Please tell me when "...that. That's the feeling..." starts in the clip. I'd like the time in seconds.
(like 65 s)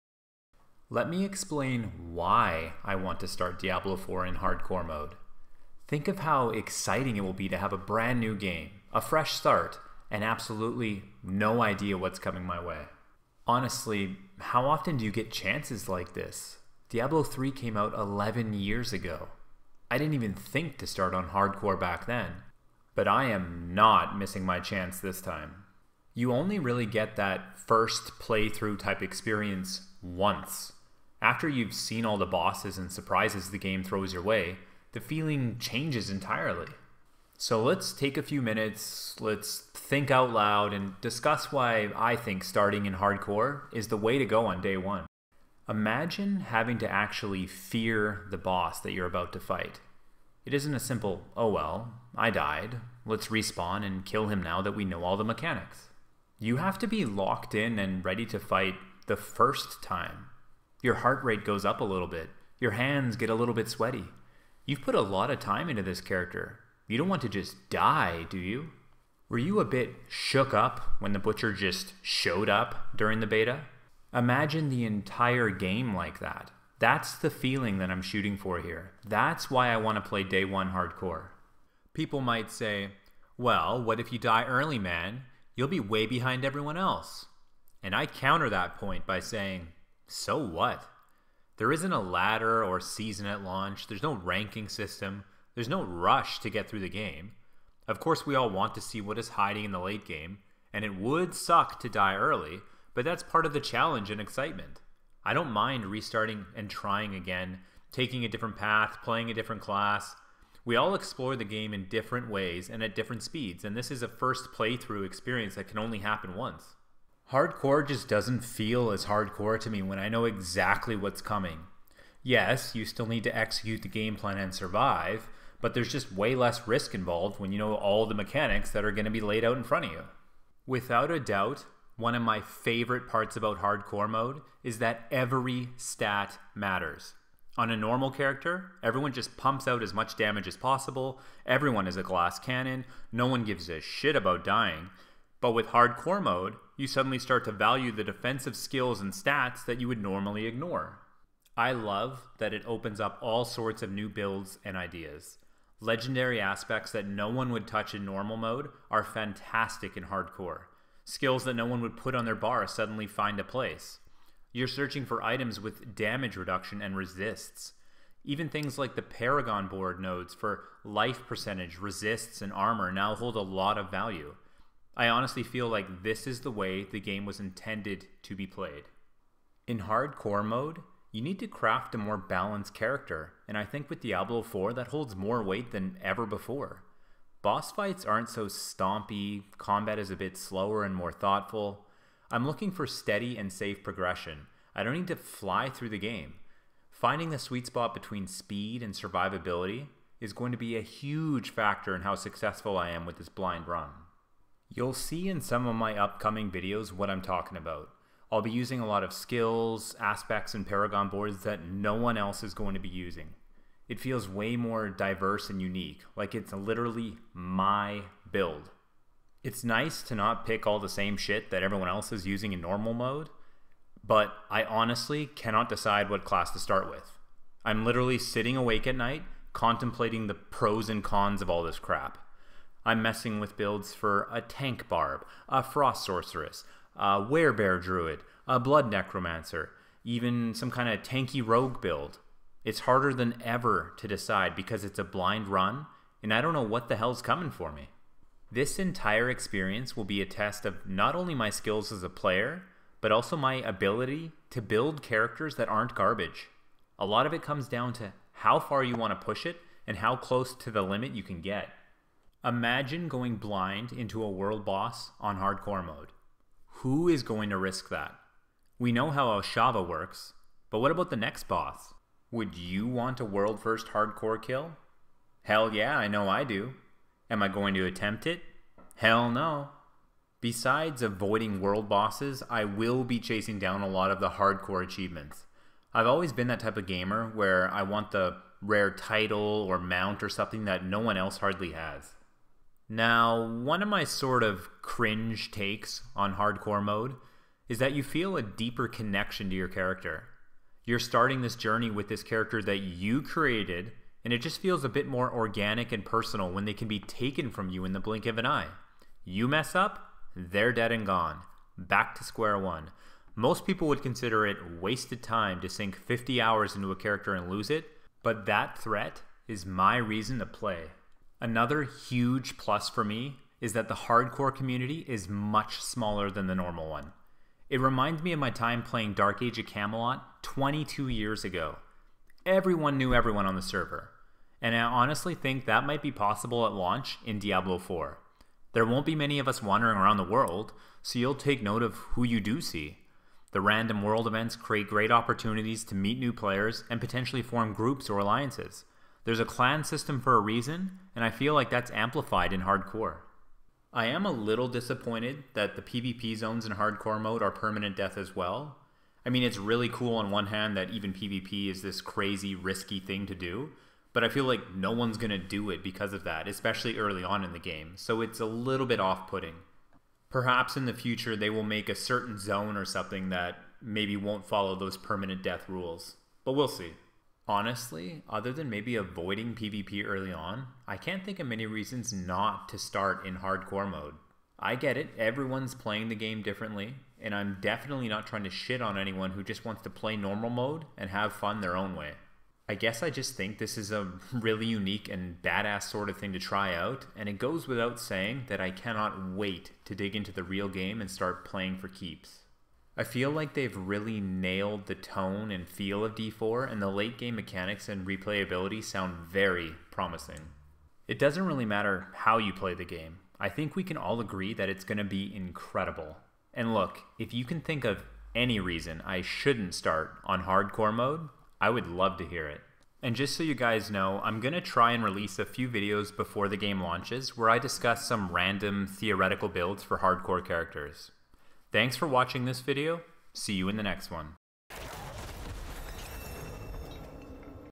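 76 s.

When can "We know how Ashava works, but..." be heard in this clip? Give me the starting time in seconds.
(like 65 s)
268 s.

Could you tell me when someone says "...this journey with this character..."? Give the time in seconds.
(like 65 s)
301 s.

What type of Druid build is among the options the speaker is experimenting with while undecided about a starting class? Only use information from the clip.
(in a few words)
Werebear.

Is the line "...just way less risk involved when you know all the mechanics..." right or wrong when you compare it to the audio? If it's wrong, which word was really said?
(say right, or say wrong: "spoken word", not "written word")
right.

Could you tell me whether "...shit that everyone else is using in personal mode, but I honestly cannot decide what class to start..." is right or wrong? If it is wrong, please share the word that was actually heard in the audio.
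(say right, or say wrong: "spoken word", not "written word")
wrong: "normal", not "personal".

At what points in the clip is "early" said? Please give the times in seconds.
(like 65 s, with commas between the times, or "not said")
84 s, 102 s, 366 s, 380 s.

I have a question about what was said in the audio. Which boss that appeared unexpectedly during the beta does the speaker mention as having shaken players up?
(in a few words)
the Butcher.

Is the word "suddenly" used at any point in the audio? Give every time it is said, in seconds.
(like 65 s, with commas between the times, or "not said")
146 s, 162 s.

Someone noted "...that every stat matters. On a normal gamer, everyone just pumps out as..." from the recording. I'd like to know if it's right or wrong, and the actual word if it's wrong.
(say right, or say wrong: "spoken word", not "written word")
wrong: "character", not "gamer".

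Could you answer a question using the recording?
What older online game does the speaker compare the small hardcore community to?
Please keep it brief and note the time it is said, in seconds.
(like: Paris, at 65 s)
Dark Age of Camelot, at 329 s.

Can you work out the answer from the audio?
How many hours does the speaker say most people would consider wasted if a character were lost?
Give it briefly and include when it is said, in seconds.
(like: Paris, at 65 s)
50, at 315 s.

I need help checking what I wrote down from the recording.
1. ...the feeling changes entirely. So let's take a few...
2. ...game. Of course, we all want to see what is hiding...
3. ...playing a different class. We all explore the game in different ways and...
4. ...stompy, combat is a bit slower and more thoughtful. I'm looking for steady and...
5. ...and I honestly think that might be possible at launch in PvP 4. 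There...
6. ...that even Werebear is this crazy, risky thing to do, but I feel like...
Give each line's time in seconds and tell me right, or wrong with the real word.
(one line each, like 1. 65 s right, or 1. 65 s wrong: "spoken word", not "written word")
1. 34 s right
2. 96 s right
3. 109 s right
4. 188 s right
5. 334 s wrong: "Diablo", not "PvP"
6. 360 s wrong: "PvP", not "Werebear".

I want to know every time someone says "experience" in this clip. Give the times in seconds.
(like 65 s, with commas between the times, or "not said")
29 s, 115 s, 249 s.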